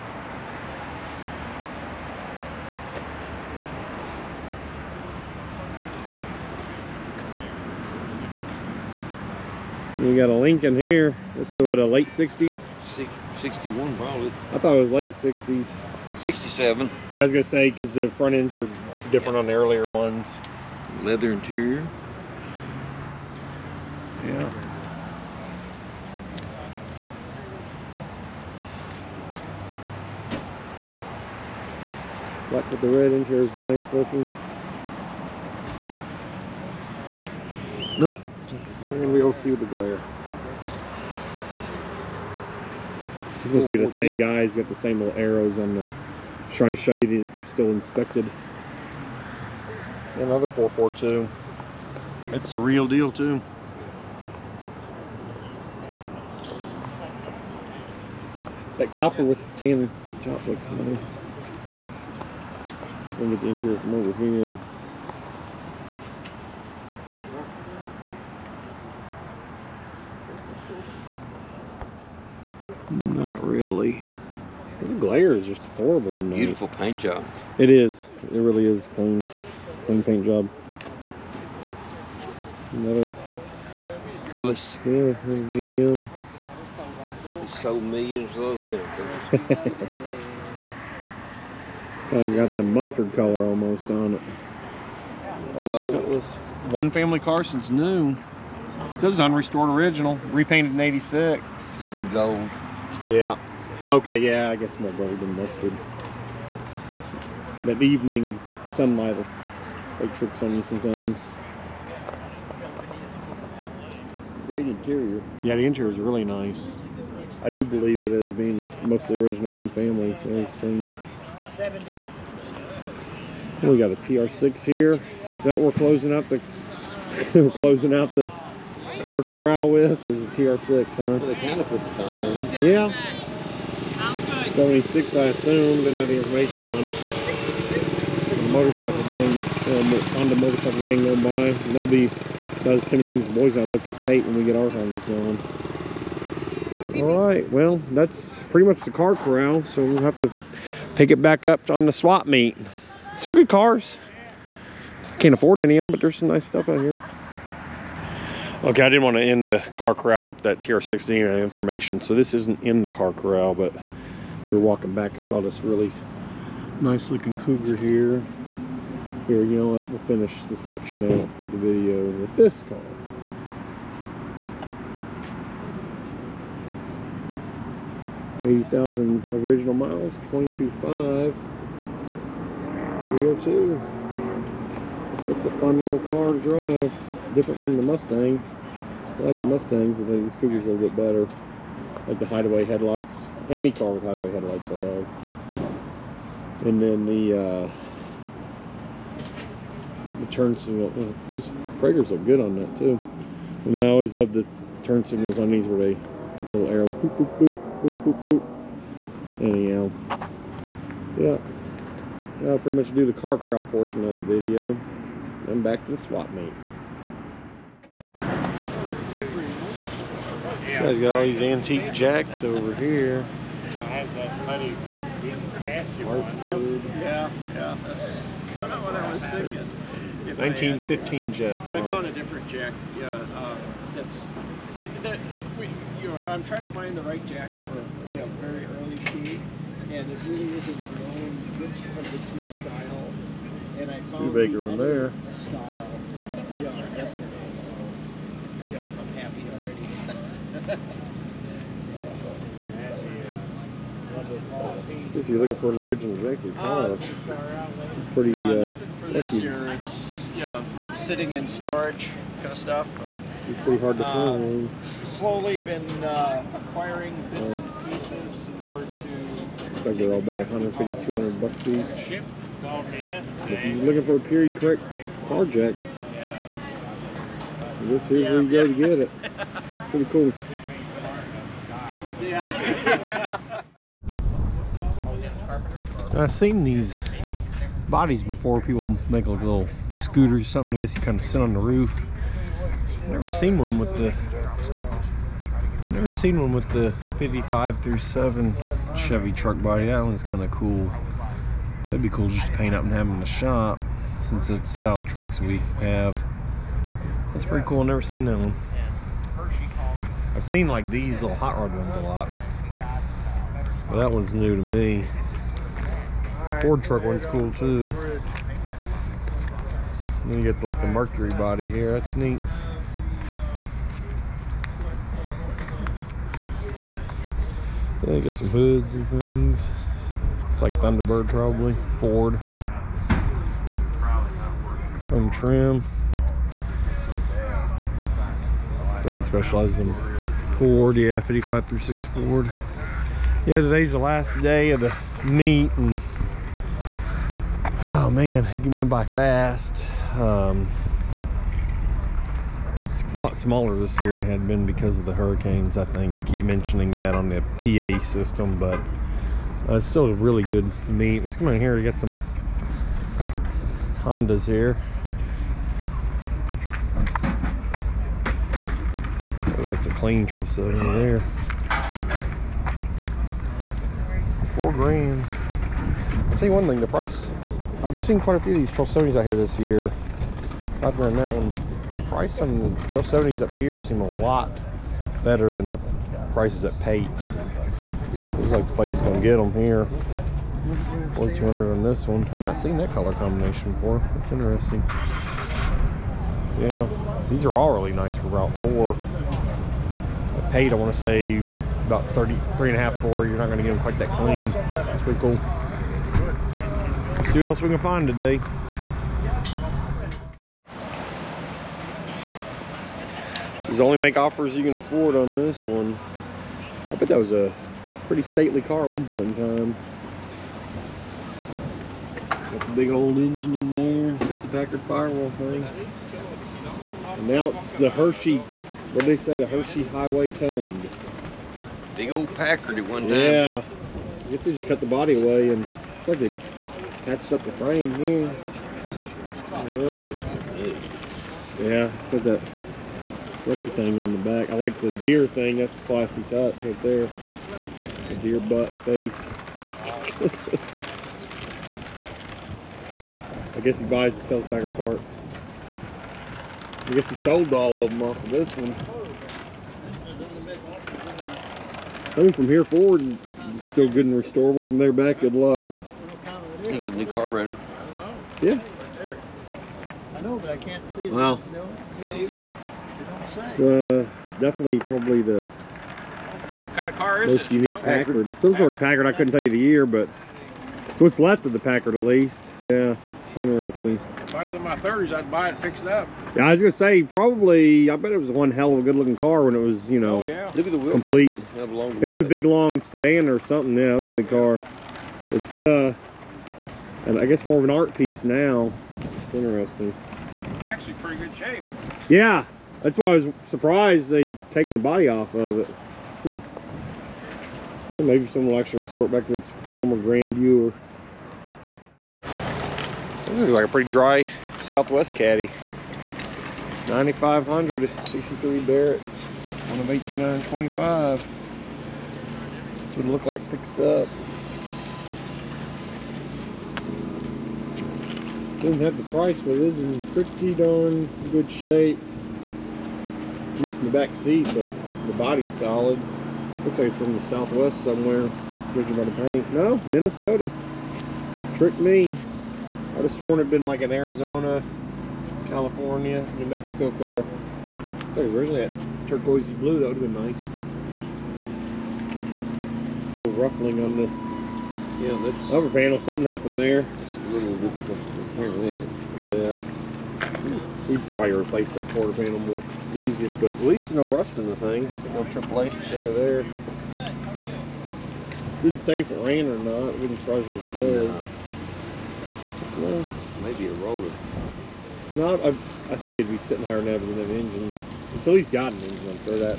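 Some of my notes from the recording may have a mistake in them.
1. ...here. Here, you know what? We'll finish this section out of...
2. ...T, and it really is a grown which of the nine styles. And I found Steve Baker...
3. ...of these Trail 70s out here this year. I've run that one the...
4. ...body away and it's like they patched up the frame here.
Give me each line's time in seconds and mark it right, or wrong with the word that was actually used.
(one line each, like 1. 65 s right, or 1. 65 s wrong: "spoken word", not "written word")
1. 167 s right
2. 238 s wrong: "two", not "nine"
3. 378 s right
4. 434 s right.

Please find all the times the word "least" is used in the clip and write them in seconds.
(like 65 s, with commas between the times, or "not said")
482 s, 563 s, 578 s.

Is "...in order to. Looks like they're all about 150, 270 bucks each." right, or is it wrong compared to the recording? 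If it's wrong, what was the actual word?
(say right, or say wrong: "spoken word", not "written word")
wrong: "200", not "270".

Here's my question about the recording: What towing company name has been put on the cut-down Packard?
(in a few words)
Hershey Highway Towing.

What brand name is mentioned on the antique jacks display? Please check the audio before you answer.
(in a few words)
Hartford.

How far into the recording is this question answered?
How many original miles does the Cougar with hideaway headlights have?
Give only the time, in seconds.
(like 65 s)
178 s.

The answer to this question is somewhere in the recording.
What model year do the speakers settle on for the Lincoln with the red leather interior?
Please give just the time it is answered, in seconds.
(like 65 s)
16 s.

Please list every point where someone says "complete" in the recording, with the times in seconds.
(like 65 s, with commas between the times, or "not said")
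490 s.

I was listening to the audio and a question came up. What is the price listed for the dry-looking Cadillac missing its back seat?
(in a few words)
9,500.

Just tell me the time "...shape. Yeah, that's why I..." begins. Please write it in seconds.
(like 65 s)
501 s.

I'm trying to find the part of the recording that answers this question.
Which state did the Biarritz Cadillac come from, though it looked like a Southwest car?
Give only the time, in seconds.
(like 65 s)
539 s.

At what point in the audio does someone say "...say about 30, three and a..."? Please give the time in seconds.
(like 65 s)
401 s.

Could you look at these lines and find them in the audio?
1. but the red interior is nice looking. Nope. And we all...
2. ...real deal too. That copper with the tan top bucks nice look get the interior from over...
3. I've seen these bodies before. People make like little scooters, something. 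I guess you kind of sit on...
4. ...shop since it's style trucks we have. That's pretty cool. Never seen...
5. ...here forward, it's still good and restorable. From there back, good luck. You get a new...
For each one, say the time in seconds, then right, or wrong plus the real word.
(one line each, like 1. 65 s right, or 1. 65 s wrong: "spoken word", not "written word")
1. 32 s right
2. 52 s wrong: "looks", not "bucks"
3. 286 s right
4. 303 s right
5. 462 s right.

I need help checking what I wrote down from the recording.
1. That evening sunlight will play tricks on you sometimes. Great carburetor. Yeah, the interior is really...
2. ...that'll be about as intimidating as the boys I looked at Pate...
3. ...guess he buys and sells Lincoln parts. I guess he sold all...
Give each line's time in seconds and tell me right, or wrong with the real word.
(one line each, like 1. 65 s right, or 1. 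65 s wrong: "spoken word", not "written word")
1. 107 s wrong: "interior", not "carburetor"
2. 141 s right
3. 453 s wrong: "Packard", not "Lincoln".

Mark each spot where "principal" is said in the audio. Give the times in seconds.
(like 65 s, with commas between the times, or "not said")
not said.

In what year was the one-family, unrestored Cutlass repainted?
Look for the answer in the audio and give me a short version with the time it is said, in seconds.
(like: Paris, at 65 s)
86, at 100 s.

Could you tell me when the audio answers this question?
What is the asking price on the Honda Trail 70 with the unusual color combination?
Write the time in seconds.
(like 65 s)
391 s.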